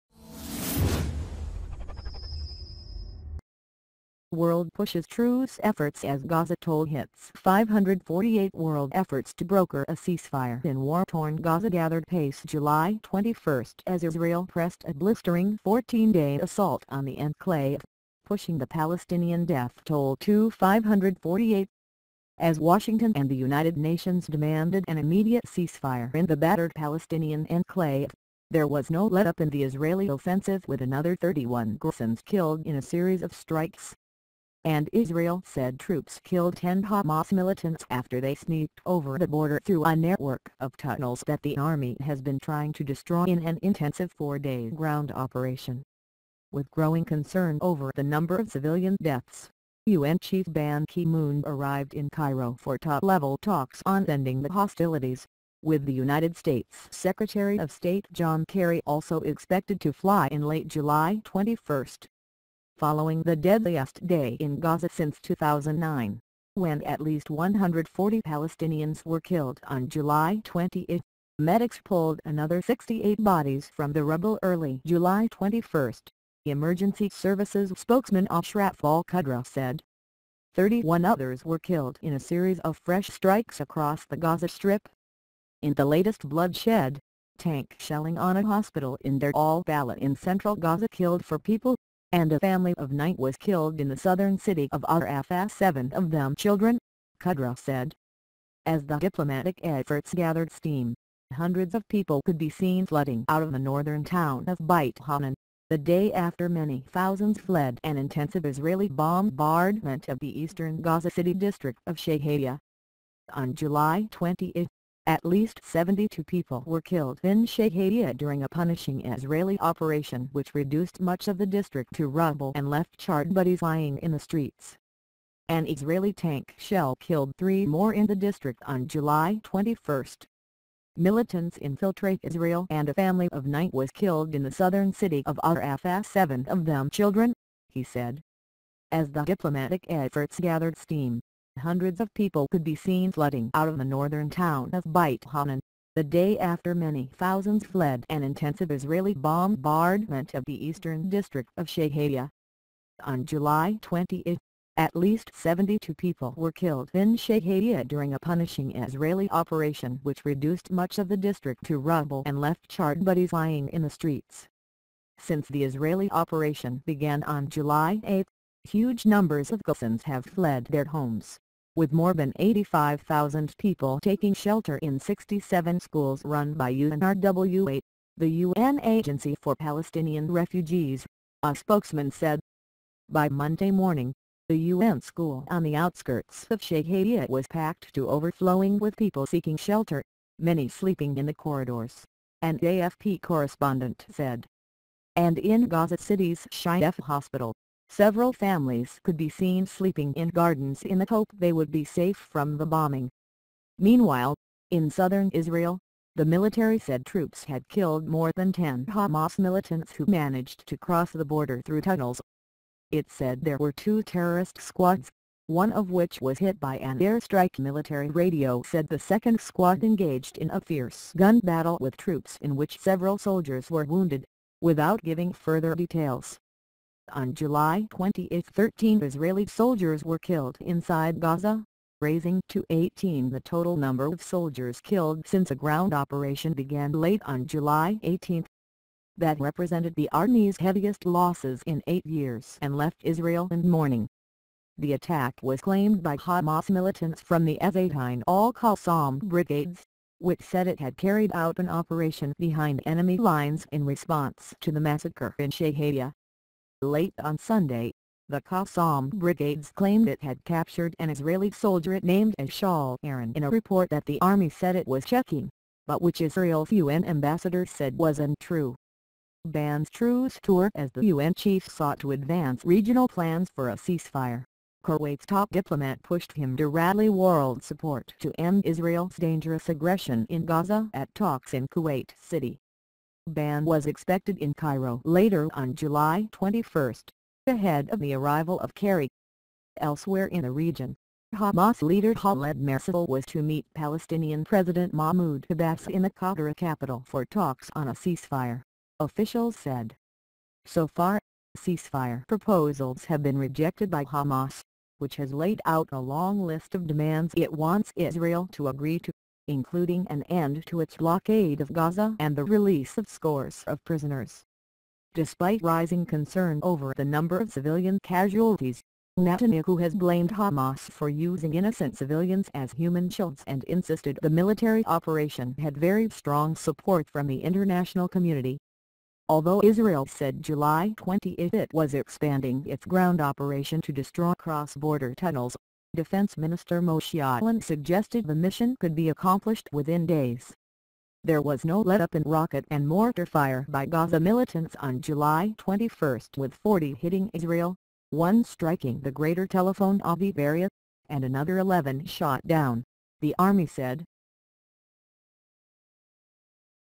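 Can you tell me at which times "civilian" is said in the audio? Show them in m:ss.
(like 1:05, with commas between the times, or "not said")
0:48, 5:17, 5:21.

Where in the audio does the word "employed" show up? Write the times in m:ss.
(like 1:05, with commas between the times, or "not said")
not said.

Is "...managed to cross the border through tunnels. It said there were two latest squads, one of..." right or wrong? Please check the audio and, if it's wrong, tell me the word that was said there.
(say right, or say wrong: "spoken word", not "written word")
wrong: "terrorist", not "latest".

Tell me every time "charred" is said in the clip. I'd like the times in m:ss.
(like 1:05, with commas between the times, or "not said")
2:02, 2:42.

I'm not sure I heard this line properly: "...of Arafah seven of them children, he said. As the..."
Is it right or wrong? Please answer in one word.
right.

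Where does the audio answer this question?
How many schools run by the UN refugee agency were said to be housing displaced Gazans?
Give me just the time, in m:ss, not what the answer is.
2:54.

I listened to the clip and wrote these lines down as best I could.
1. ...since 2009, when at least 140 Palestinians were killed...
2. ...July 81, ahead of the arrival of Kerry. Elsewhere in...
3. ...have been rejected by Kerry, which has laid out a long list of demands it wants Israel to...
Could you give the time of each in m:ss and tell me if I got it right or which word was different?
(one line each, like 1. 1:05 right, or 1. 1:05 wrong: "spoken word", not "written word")
1. 1:04 right
2. 4:45 wrong: "21", not "81"
3. 5:03 wrong: "Hamas", not "Kerry".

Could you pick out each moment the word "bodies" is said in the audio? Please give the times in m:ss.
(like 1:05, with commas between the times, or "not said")
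1:13, 2:03, 2:43.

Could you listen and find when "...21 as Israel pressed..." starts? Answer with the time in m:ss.
0:13.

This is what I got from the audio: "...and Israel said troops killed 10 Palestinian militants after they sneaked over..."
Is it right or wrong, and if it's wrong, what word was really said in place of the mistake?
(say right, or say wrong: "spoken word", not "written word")
wrong: "Hamas", not "Palestinian".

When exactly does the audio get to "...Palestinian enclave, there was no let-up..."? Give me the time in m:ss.
0:26.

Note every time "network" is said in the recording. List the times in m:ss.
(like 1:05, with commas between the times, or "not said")
0:39.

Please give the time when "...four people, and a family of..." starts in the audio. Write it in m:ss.
1:31.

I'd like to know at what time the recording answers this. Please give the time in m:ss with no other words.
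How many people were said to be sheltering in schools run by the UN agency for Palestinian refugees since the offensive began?
2:52.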